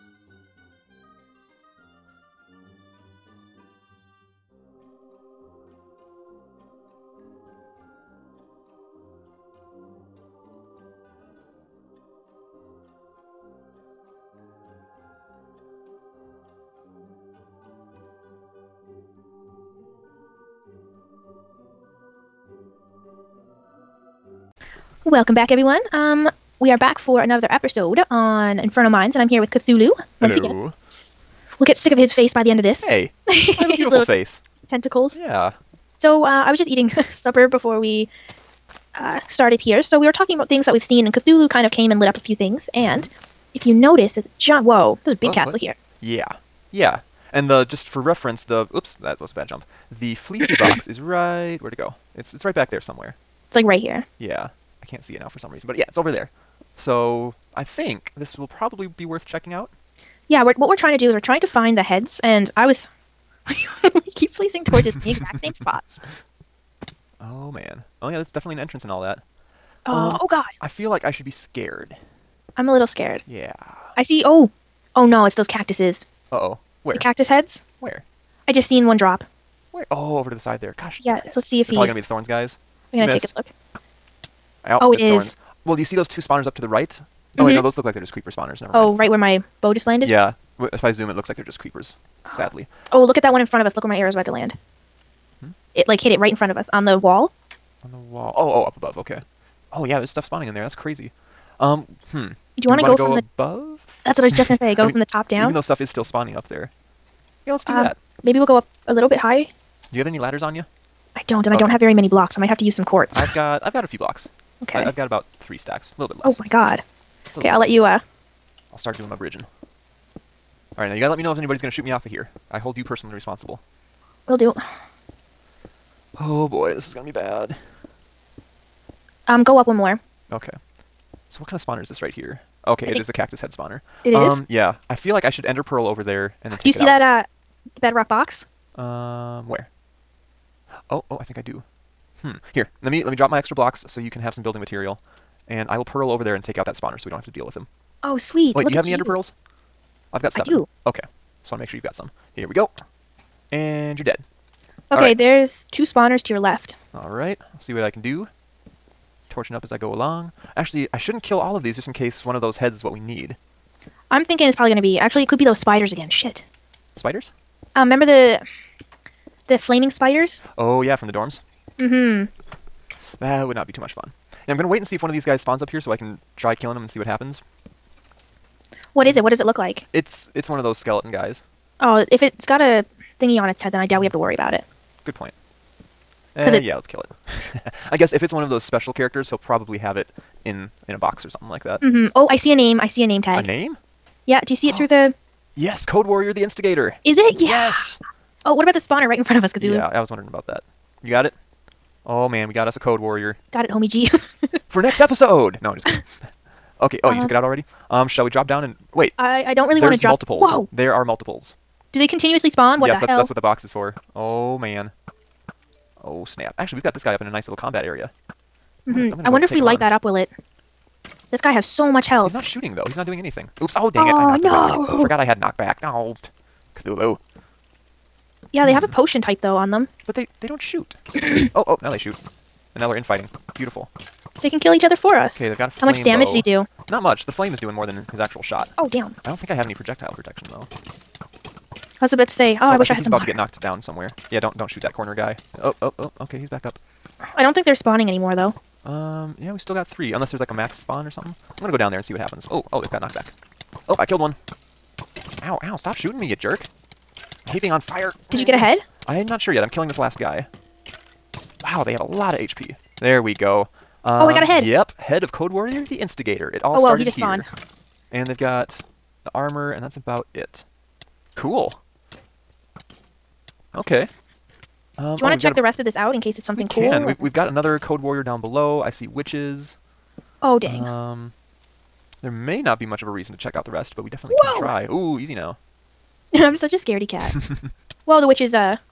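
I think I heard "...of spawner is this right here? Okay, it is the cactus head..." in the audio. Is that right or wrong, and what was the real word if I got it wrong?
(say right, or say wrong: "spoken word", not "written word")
right.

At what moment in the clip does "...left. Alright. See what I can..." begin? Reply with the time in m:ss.
2:36.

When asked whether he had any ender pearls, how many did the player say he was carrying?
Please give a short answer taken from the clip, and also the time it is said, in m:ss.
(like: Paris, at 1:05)
7, at 2:30.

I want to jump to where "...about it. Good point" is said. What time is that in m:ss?
3:04.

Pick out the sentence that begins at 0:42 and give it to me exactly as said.
And mm-hmm if you notice, there's a giant.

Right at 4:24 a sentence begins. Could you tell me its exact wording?
Yep, head of Code Warrior, the Instigator.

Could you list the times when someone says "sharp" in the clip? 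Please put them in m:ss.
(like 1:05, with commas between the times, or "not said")
not said.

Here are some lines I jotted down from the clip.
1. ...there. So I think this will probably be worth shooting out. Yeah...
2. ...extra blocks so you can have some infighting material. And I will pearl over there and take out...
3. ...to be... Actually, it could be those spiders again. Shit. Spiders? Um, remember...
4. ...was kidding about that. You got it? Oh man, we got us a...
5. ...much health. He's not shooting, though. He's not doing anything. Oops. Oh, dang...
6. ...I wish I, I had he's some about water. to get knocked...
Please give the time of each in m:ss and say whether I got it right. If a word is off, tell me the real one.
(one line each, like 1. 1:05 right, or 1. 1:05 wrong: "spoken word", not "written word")
1. 0:56 wrong: "checking", not "shooting"
2. 2:23 wrong: "building", not "infighting"
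3. 2:44 right
4. 3:19 wrong: "wondering", not "kidding"
5. 3:41 right
6. 4:02 right.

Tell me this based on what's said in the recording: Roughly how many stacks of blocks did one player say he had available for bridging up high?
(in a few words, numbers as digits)
3.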